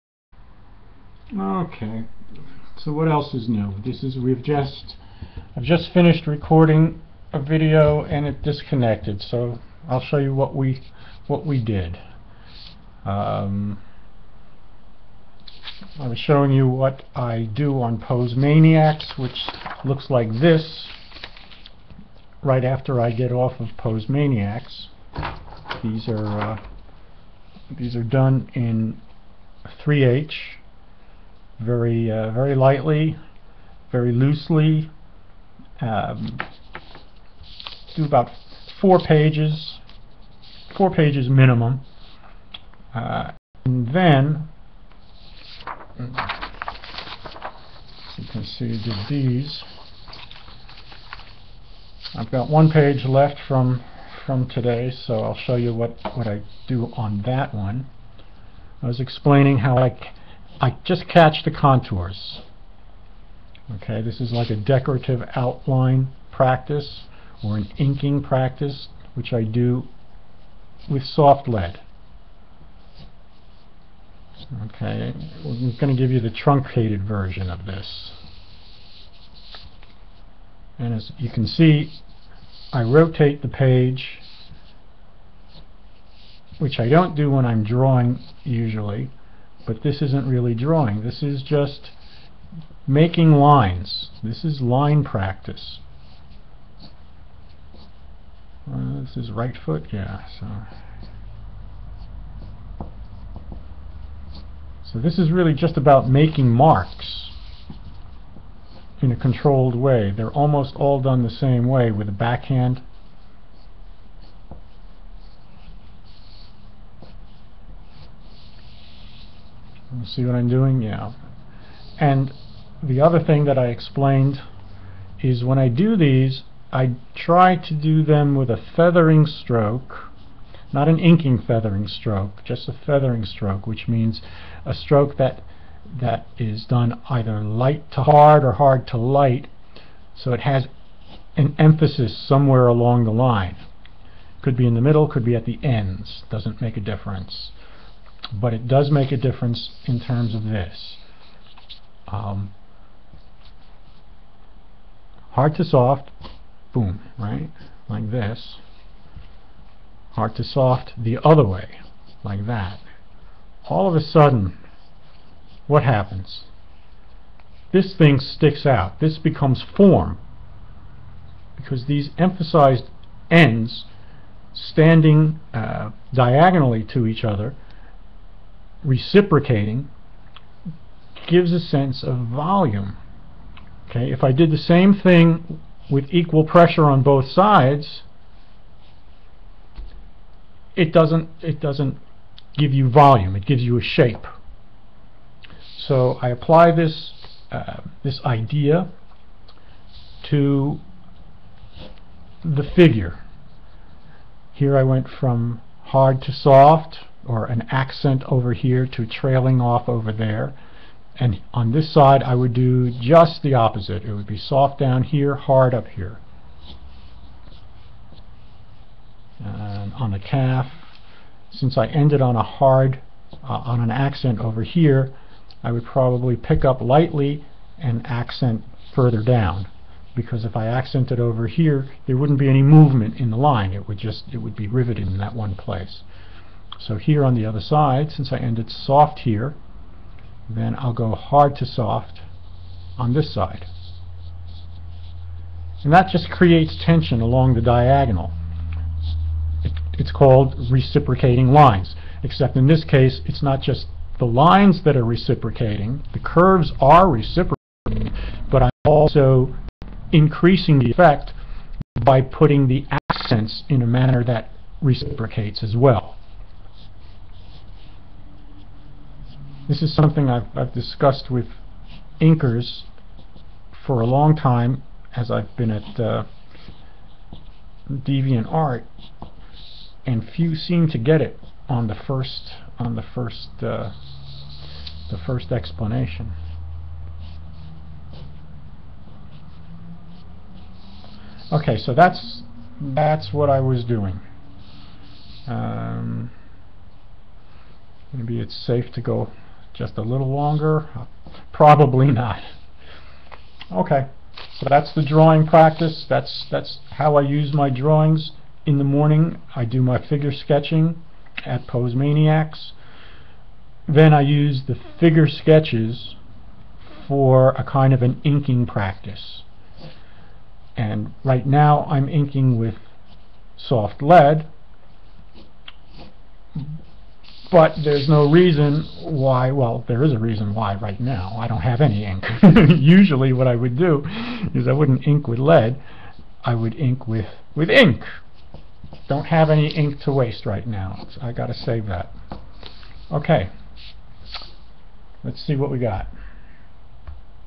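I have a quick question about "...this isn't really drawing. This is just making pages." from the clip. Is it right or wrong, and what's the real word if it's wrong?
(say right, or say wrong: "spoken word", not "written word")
wrong: "lines", not "pages".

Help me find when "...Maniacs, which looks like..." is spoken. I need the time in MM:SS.
00:18.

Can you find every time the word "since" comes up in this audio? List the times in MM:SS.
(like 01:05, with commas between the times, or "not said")
03:41, 03:58.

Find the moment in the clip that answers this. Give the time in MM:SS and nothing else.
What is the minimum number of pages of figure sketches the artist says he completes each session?
00:40.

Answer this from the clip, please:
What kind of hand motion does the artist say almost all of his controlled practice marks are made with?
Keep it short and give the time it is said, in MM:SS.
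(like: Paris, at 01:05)
backhand, at 01:52.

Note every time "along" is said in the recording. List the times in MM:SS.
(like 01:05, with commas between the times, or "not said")
02:22, 04:07.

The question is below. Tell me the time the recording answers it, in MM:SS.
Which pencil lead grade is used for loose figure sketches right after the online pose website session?
00:29.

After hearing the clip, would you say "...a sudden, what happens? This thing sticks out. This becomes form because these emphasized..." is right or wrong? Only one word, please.
right.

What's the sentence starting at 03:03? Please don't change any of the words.
Okay, if I did the same thing with equal pressure on both sides, it doesn't it doesn't give you volume.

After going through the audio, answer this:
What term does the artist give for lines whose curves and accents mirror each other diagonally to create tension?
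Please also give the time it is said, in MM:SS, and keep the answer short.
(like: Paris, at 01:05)
reciprocating lines, at 04:10.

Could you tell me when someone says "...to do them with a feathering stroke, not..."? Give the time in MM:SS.
02:07.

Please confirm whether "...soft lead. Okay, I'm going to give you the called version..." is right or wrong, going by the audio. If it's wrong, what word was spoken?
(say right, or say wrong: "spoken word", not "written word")
wrong: "truncated", not "called".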